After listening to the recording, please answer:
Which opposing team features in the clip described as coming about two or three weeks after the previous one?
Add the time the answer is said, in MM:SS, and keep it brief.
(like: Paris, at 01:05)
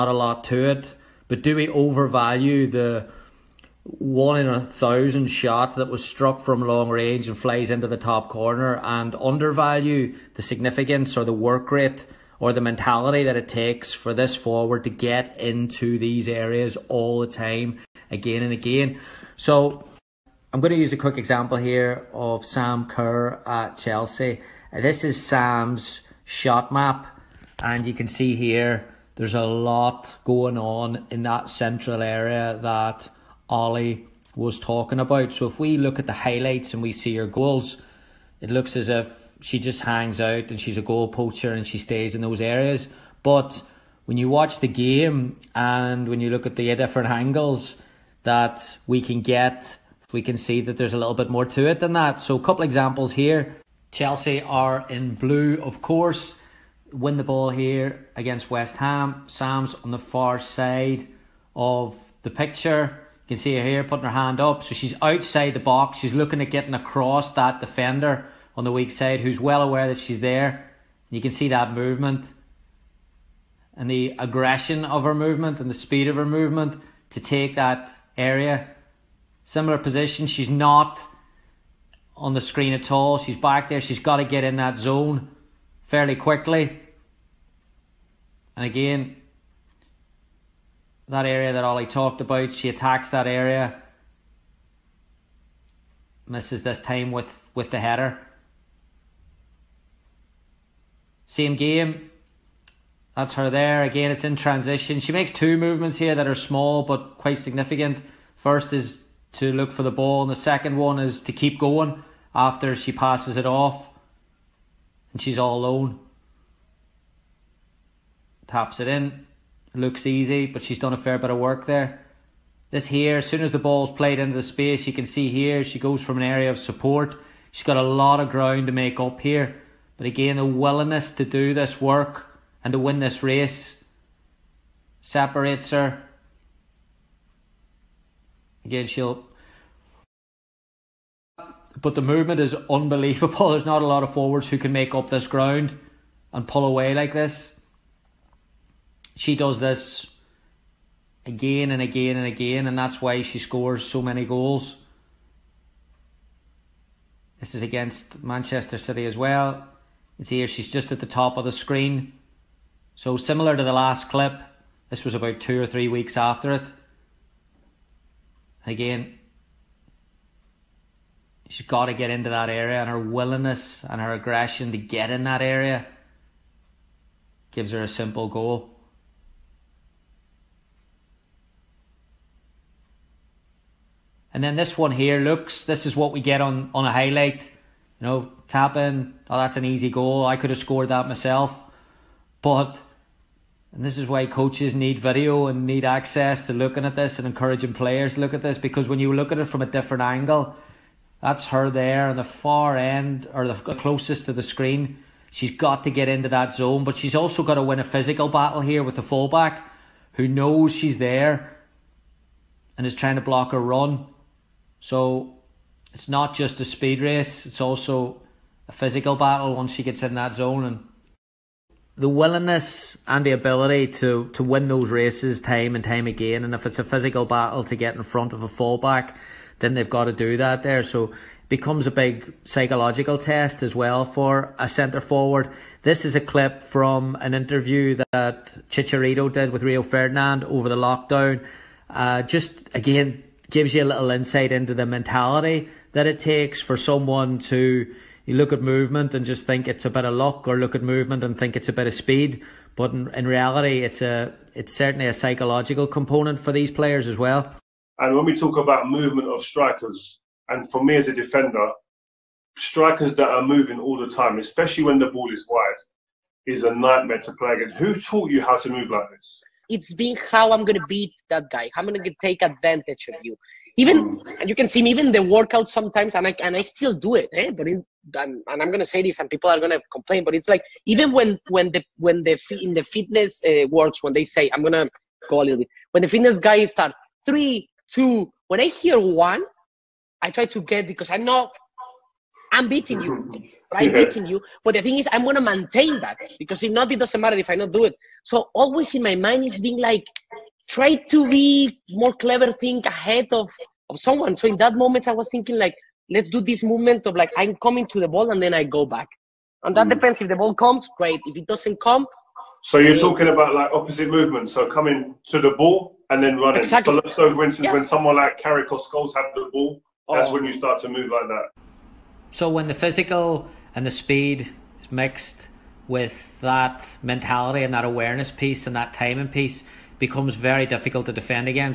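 Manchester City, at 02:38.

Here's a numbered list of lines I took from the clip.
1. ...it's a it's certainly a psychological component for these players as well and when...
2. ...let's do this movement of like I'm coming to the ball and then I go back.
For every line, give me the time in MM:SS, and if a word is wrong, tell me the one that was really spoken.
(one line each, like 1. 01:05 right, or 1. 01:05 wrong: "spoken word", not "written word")
1. 04:13 right
2. 05:06 right.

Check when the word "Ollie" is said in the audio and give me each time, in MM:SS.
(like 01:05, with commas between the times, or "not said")
00:33, 01:31.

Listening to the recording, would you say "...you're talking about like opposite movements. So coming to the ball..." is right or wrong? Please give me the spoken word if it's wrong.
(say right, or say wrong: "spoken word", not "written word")
right.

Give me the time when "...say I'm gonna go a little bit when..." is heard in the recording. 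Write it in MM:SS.
04:44.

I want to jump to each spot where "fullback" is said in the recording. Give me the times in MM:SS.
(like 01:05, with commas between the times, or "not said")
03:29, 03:48.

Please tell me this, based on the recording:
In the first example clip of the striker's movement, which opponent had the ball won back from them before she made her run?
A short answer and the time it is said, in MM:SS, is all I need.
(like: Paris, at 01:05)
West Ham, at 00:58.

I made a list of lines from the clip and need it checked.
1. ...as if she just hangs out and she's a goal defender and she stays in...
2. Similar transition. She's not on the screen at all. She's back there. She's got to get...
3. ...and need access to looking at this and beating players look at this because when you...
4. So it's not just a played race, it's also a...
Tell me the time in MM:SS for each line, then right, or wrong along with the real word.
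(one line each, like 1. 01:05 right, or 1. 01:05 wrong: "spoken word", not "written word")
1. 00:38 wrong: "poacher", not "defender"
2. 01:19 wrong: "position", not "transition"
3. 03:15 wrong: "encouraging", not "beating"
4. 03:34 wrong: "speed", not "played".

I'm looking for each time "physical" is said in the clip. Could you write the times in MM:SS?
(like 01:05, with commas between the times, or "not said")
03:27, 03:38, 03:46, 05:22.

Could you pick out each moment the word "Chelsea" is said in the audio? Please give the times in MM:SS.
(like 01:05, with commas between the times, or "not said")
00:23, 00:53.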